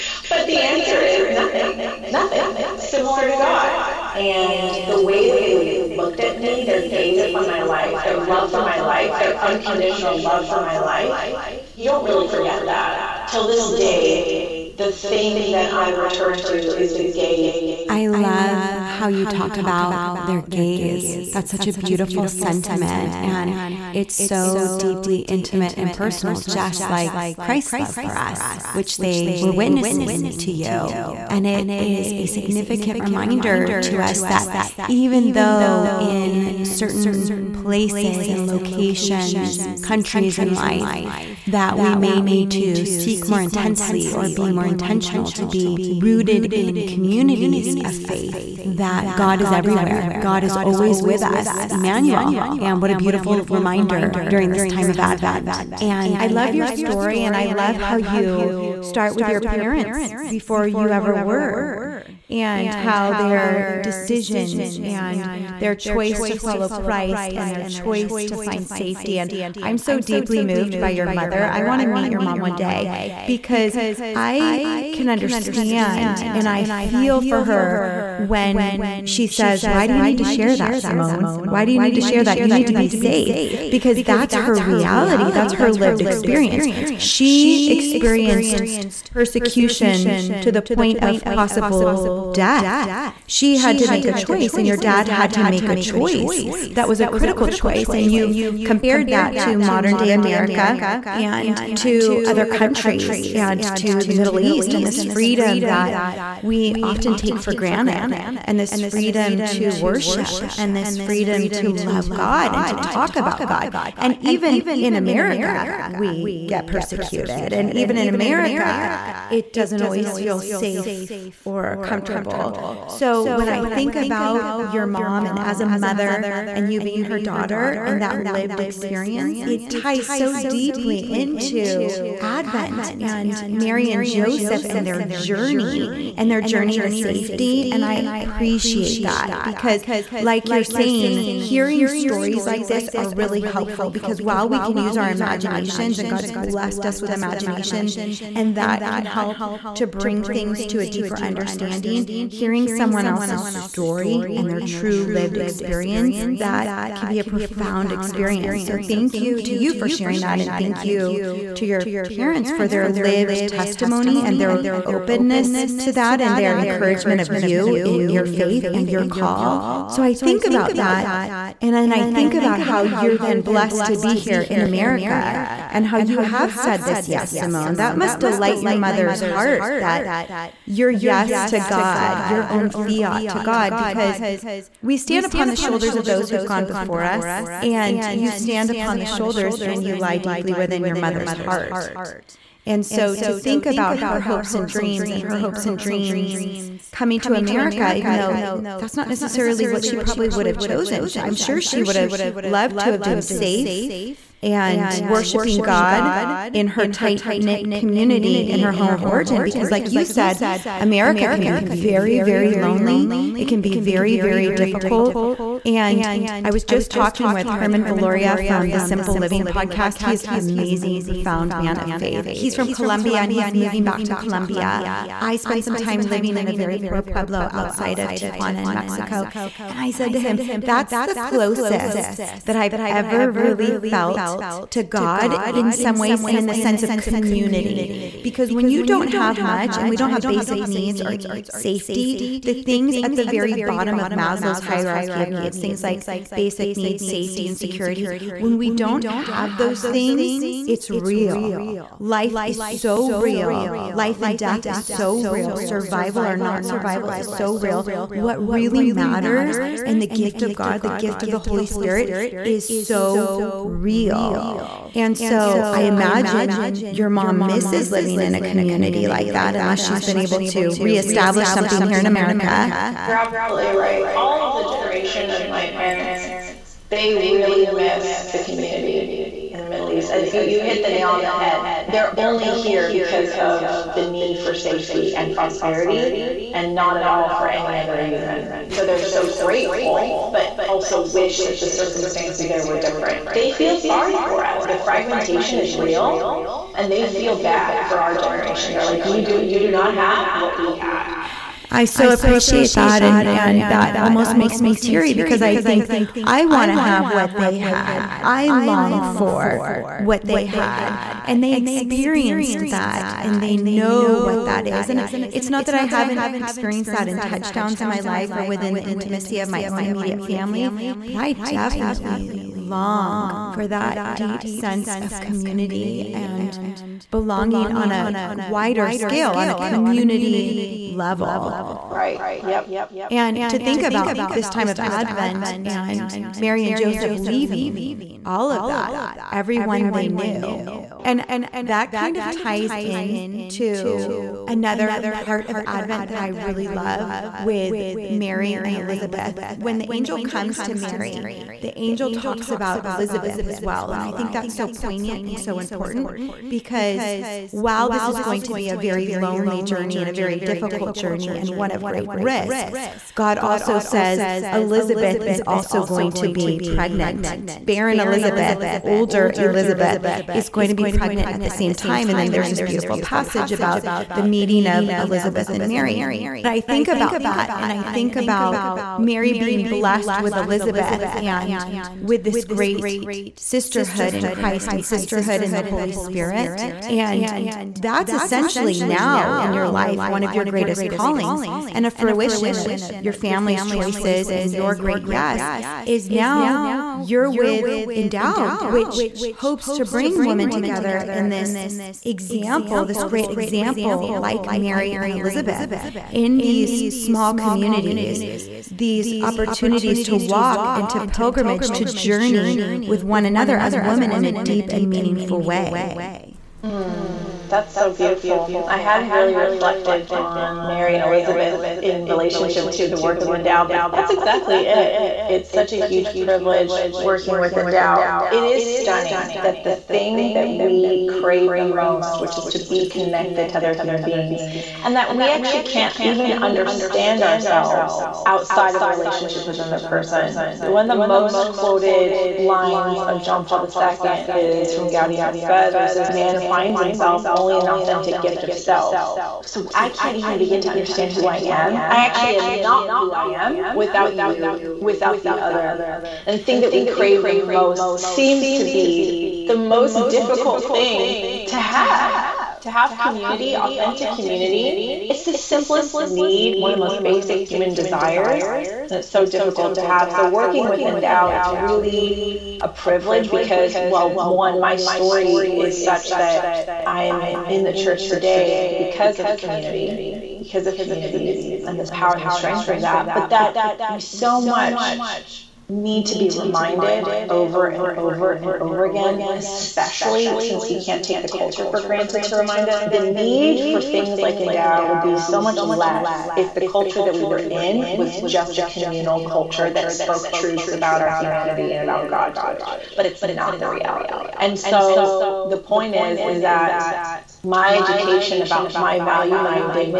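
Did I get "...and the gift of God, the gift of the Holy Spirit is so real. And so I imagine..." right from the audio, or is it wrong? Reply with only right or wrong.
right.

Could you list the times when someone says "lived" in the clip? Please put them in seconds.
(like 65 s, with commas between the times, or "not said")
85 s, 128 s, 155 s, 162 s.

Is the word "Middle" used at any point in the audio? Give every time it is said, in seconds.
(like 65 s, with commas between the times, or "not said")
104 s, 279 s.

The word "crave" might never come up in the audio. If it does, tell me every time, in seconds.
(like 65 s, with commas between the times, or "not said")
431 s, 456 s.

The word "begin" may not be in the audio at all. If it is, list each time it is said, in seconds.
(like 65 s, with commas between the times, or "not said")
450 s.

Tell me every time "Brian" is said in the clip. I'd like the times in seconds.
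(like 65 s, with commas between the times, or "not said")
not said.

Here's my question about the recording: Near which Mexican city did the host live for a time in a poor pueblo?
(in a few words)
Tijuana.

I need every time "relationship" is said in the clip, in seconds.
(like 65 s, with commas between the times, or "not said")
422 s, 438 s.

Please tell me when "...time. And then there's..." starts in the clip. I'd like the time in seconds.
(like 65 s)
371 s.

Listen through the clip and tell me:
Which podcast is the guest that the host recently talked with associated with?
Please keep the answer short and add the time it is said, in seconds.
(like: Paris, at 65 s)
Simple Living podcast, at 218 s.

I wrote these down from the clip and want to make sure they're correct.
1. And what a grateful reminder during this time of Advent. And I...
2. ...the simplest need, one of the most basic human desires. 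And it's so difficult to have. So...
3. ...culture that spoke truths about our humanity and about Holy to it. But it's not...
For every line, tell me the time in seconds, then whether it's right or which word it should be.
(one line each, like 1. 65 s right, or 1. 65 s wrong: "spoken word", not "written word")
1. 52 s wrong: "beautiful", not "grateful"
2. 465 s right
3. 499 s wrong: "God", not "Holy".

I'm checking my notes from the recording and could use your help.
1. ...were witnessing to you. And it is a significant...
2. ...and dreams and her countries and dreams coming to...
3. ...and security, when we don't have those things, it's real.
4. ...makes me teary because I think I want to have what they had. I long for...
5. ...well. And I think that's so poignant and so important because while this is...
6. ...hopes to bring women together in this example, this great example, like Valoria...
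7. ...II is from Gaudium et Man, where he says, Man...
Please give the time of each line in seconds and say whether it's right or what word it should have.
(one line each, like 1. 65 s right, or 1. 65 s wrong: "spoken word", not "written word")
1. 29 s right
2. 194 s wrong: "hopes", not "countries"
3. 247 s right
4. 304 s right
5. 353 s right
6. 399 s wrong: "Mary", not "Valoria"
7. 443 s wrong: "Spes", not "Man".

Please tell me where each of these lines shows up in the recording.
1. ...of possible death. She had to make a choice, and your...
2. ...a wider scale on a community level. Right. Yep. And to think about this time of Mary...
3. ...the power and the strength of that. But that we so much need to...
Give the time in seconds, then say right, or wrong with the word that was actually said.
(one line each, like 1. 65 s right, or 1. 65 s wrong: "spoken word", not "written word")
1. 91 s right
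2. 327 s wrong: "Advent", not "Mary"
3. 481 s right.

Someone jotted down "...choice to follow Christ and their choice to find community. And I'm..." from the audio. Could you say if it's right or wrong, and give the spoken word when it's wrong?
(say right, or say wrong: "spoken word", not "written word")
wrong: "safety", not "community".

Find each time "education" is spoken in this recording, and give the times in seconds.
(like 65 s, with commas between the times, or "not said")
507 s.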